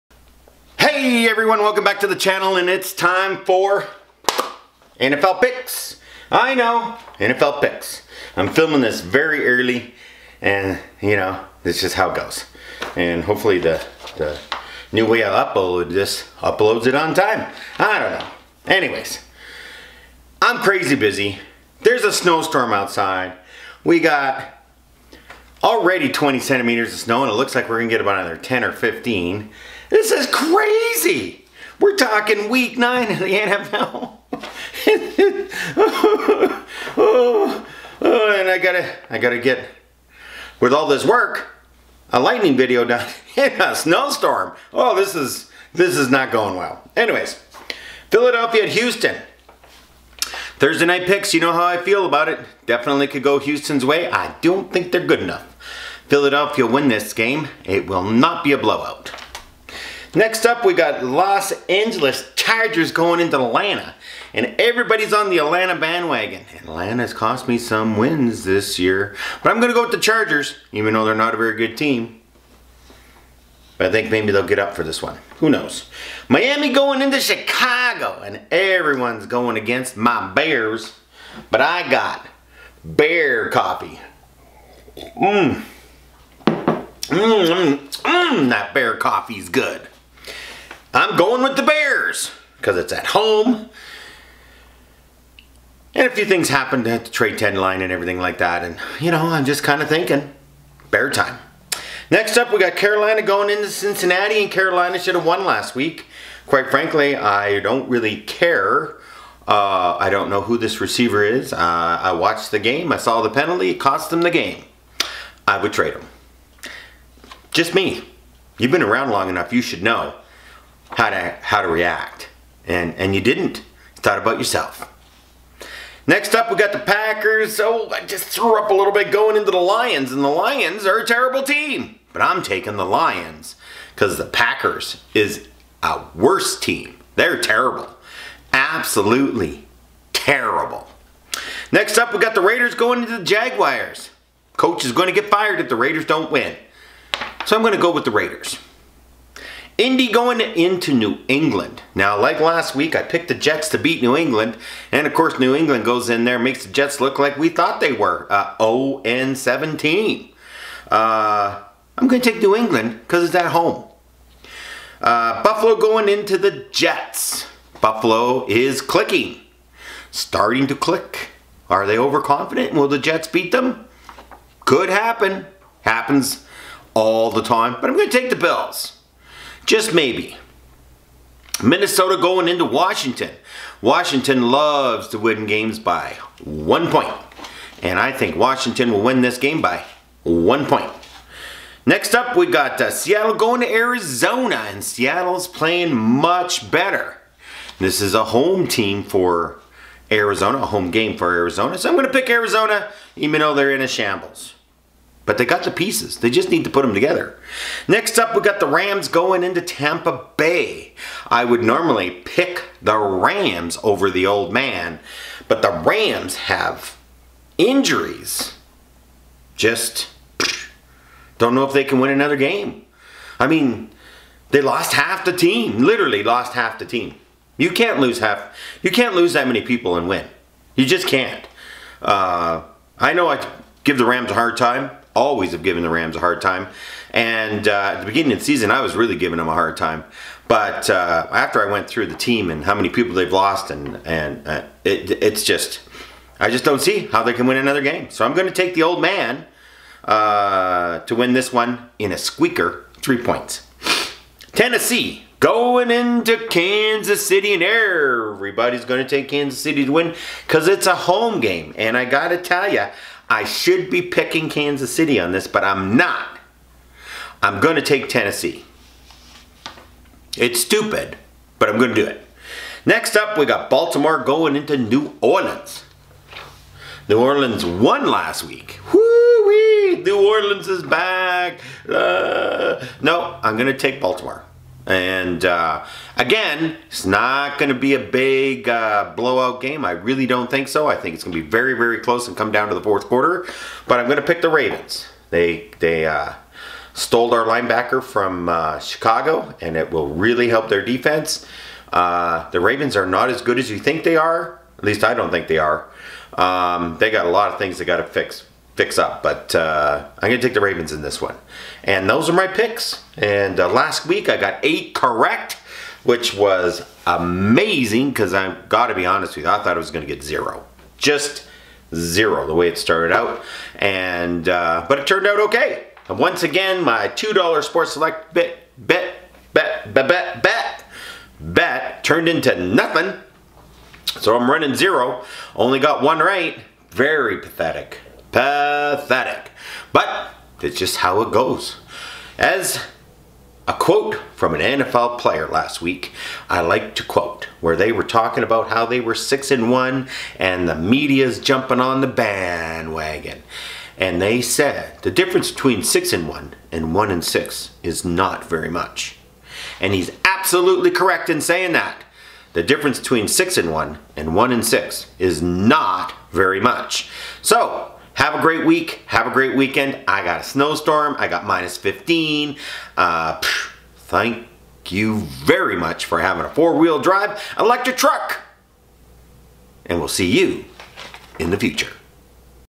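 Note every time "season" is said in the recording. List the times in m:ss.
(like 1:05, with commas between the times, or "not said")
3:58.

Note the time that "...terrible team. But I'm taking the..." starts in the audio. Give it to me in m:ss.
2:11.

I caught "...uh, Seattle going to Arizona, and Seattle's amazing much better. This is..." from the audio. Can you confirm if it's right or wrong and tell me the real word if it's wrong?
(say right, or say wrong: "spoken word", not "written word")
wrong: "playing", not "amazing".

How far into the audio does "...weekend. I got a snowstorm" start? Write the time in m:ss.
6:09.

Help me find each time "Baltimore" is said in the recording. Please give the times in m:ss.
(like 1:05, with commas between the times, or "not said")
4:33, 4:44.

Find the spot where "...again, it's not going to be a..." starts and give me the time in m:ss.
4:46.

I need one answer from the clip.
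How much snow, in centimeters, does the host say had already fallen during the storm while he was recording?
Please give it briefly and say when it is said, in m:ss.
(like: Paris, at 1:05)
20, at 0:26.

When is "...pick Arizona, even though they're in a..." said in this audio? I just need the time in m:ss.
3:22.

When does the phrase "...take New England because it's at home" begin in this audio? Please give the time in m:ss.
2:42.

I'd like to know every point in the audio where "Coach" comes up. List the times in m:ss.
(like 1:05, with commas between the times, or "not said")
2:24.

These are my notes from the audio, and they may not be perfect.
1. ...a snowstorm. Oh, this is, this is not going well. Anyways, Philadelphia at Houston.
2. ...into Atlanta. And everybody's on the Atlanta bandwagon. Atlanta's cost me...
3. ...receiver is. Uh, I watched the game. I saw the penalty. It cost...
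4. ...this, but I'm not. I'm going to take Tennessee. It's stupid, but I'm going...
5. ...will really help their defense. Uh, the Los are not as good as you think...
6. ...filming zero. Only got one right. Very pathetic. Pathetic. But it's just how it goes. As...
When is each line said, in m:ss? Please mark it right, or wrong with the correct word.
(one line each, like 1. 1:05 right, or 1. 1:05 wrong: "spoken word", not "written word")
1. 0:43 right
2. 1:03 right
3. 1:50 right
4. 4:25 right
5. 4:59 wrong: "Ravens", not "Los"
6. 5:34 wrong: "running", not "filming".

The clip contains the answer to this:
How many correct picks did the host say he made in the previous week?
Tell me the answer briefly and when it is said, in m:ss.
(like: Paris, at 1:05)
8, at 5:14.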